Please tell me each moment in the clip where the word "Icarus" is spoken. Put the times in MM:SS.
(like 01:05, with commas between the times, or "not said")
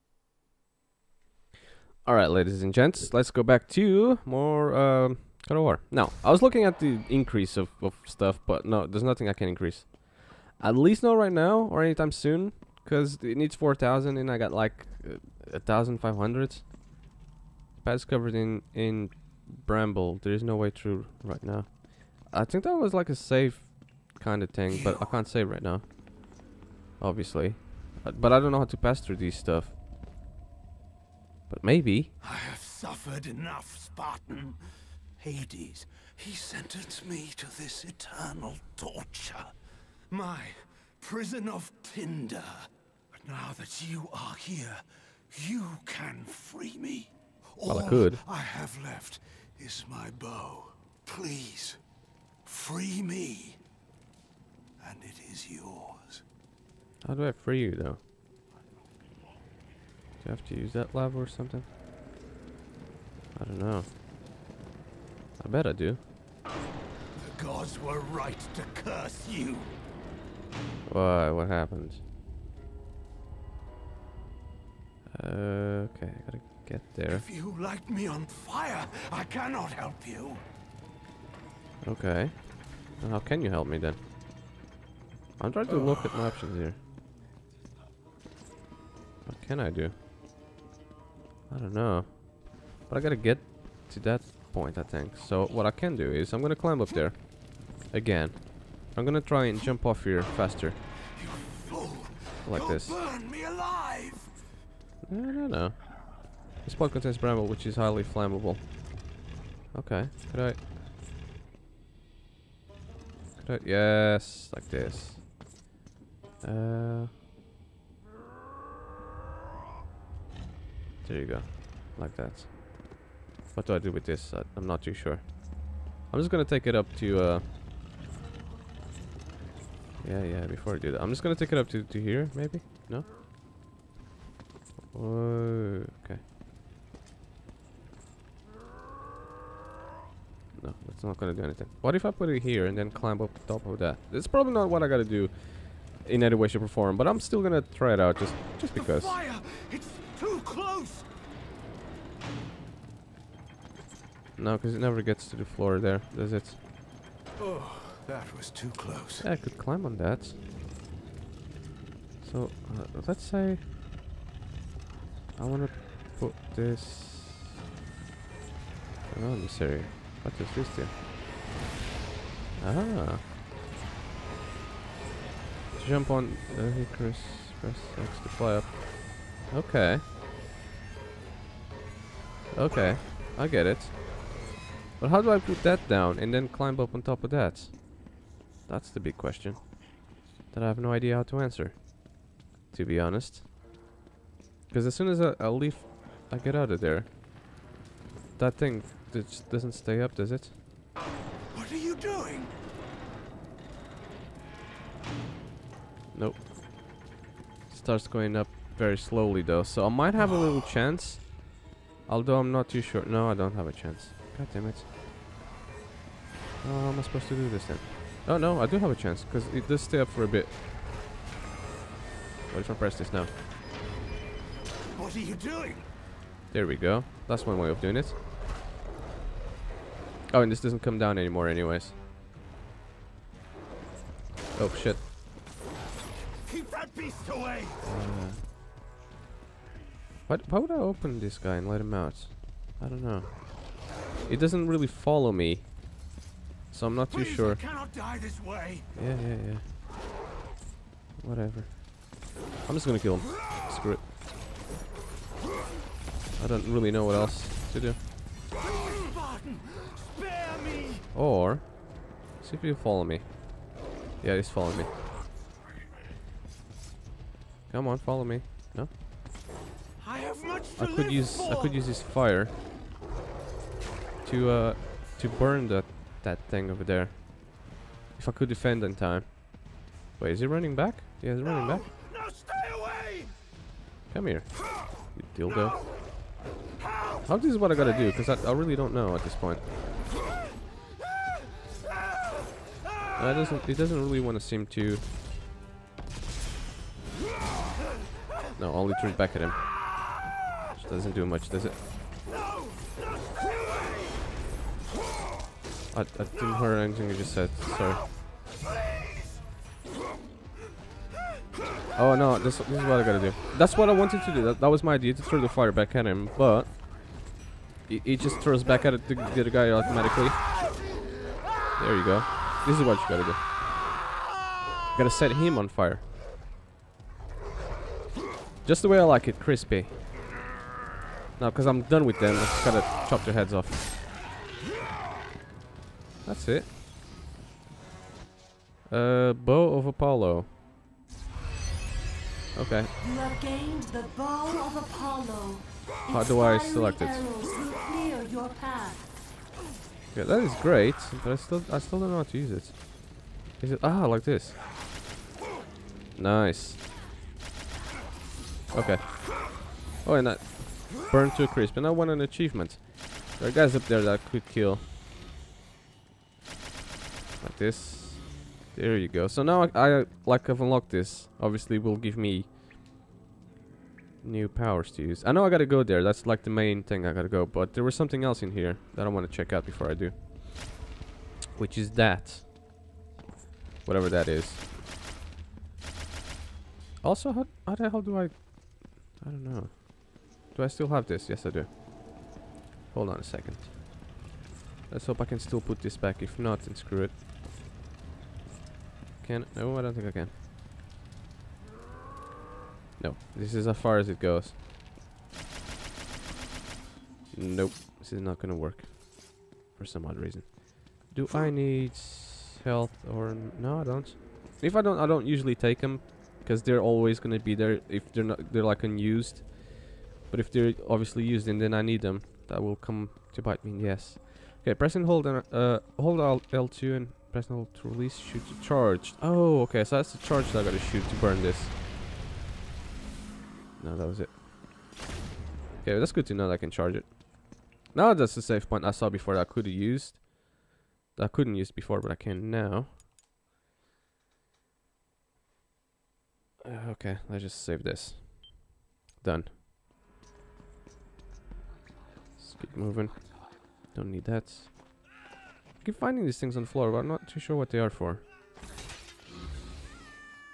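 02:56.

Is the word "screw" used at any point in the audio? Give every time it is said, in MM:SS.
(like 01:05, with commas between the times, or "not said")
04:13, 06:36.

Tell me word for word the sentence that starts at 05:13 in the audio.
That's what I wanted to do, that, that was my idea, to throw the fire back at him, but...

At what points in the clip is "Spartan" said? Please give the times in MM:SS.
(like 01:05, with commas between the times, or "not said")
00:33.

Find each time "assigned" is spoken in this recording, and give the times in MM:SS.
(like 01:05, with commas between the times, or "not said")
not said.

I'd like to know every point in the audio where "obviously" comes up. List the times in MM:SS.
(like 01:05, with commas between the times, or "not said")
00:27, 06:11, 07:00.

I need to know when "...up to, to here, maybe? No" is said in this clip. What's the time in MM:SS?
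02:11.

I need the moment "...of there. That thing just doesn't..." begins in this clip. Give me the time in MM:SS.
03:16.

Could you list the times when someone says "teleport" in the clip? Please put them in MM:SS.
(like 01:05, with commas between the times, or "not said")
not said.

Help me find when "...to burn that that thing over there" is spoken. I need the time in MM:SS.
04:35.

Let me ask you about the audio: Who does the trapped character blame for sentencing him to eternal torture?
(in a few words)
Hades.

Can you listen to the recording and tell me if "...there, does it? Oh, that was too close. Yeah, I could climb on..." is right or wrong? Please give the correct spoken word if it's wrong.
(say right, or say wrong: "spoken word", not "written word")
right.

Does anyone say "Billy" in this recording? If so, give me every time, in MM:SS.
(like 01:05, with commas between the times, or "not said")
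not said.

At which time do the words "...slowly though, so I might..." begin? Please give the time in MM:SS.
03:28.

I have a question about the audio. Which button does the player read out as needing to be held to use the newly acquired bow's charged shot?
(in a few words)
L2.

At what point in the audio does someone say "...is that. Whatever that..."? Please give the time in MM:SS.
06:21.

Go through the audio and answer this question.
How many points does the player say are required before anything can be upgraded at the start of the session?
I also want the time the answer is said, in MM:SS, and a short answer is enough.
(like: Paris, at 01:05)
4,000, at 00:13.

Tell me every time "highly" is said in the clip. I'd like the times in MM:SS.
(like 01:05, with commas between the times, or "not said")
01:47.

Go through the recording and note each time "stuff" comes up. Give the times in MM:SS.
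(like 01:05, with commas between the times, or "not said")
00:08, 00:29.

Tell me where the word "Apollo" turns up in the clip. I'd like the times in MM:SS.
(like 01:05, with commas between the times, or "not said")
05:39, 05:44.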